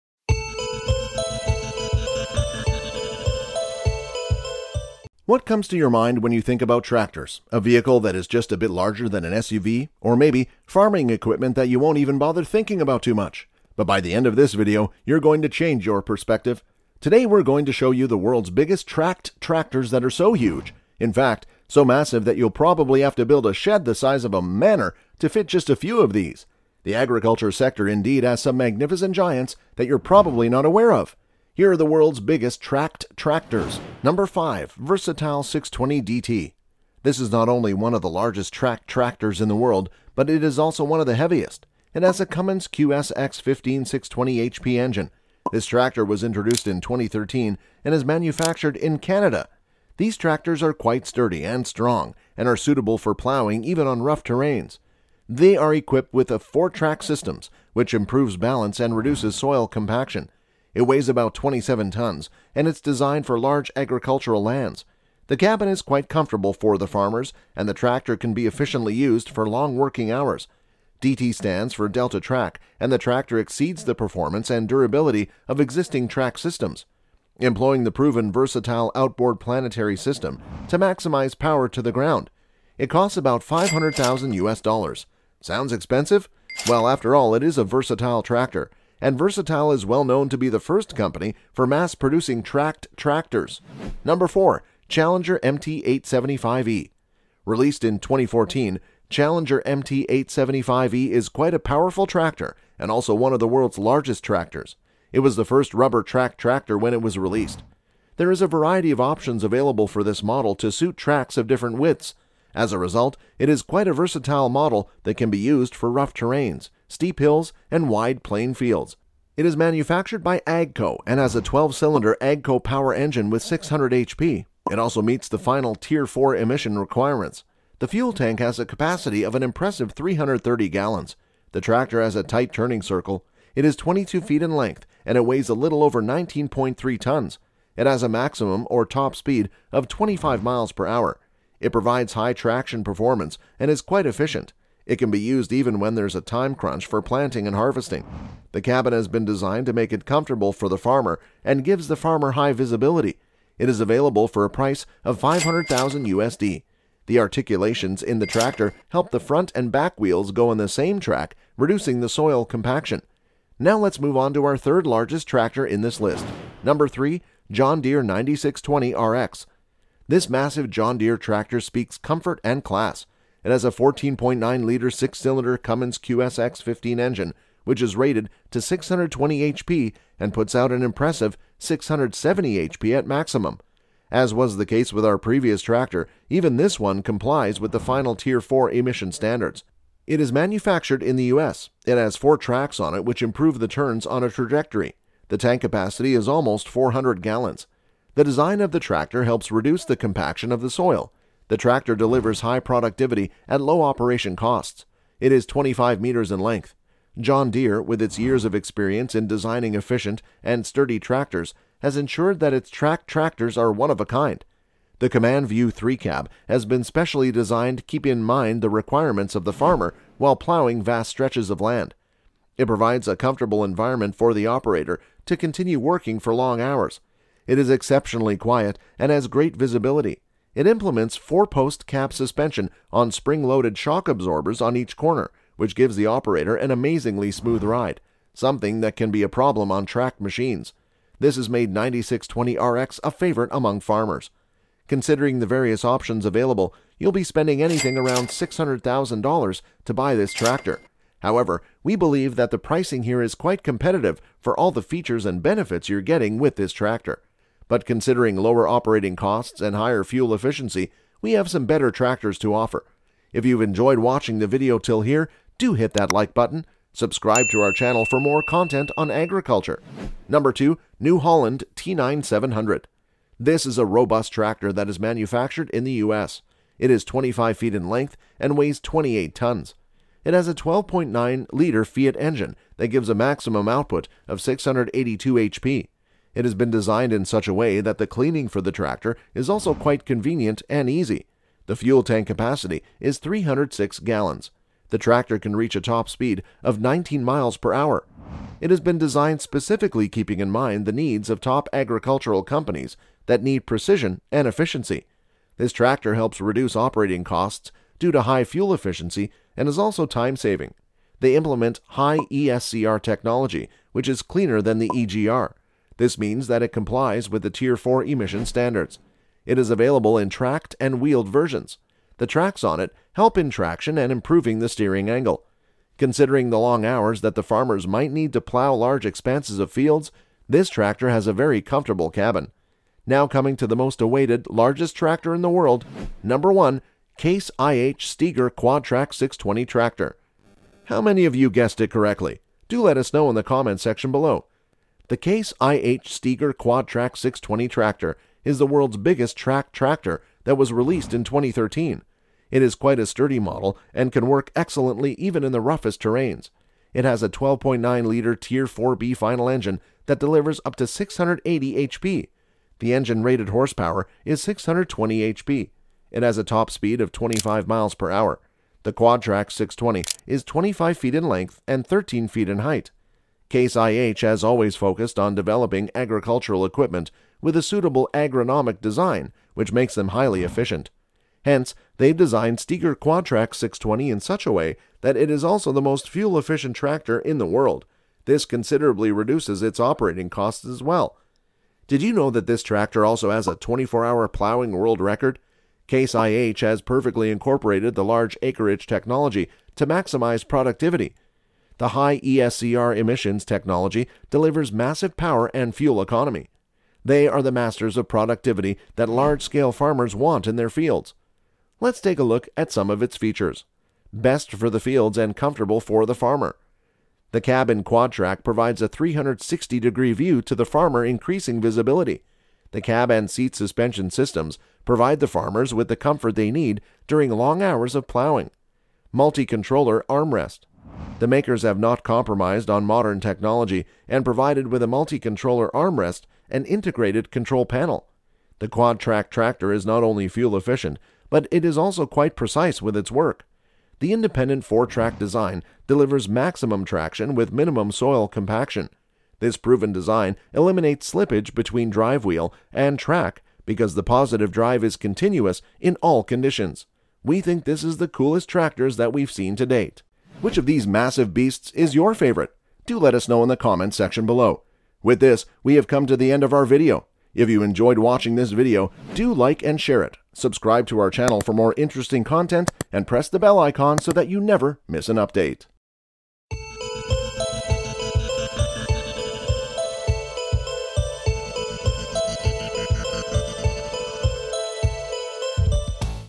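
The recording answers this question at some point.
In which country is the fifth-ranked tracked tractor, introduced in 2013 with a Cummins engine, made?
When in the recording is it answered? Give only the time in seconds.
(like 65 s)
48 s.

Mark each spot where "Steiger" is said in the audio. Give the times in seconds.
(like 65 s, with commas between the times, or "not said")
338 s, 346 s, 382 s.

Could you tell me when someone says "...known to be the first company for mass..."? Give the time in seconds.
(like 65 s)
90 s.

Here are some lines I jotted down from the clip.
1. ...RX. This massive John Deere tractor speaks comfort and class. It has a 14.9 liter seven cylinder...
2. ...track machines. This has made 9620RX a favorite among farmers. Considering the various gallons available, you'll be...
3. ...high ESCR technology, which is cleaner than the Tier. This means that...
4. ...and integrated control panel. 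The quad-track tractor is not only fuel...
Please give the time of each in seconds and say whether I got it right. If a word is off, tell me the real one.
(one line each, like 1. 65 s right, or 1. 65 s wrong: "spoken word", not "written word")
1. 168 s wrong: "six", not "seven"
2. 239 s wrong: "options", not "gallons"
3. 311 s wrong: "EGR", not "Tier"
4. 436 s right.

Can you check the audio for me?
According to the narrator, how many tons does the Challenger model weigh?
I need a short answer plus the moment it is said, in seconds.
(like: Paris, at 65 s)
a little over 19.3 tons, at 135 s.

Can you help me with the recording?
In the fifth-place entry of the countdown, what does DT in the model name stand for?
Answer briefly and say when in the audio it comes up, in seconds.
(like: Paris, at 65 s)
DeltaTrack, at 71 s.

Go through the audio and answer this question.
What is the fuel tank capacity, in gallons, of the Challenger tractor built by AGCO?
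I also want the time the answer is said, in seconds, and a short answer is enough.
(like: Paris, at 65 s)
330 gallons, at 129 s.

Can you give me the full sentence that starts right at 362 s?
The engine rated horsepower is 620 HP.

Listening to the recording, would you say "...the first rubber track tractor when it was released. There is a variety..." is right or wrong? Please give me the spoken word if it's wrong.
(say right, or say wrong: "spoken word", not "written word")
right.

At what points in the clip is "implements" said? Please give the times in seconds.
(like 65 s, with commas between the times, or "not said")
230 s, 311 s.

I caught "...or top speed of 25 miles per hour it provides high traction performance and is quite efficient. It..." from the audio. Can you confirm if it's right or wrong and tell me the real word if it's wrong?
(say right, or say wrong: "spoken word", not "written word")
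right.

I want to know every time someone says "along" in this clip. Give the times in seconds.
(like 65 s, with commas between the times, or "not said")
not said.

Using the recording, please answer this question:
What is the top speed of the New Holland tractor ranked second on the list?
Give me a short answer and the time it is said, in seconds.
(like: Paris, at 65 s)
19 miles per hour, at 296 s.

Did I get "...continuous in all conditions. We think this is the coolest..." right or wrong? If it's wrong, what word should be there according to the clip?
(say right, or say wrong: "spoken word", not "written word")
right.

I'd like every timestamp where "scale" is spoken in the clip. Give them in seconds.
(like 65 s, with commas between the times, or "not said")
409 s.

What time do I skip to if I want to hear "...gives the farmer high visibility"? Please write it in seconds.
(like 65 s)
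151 s.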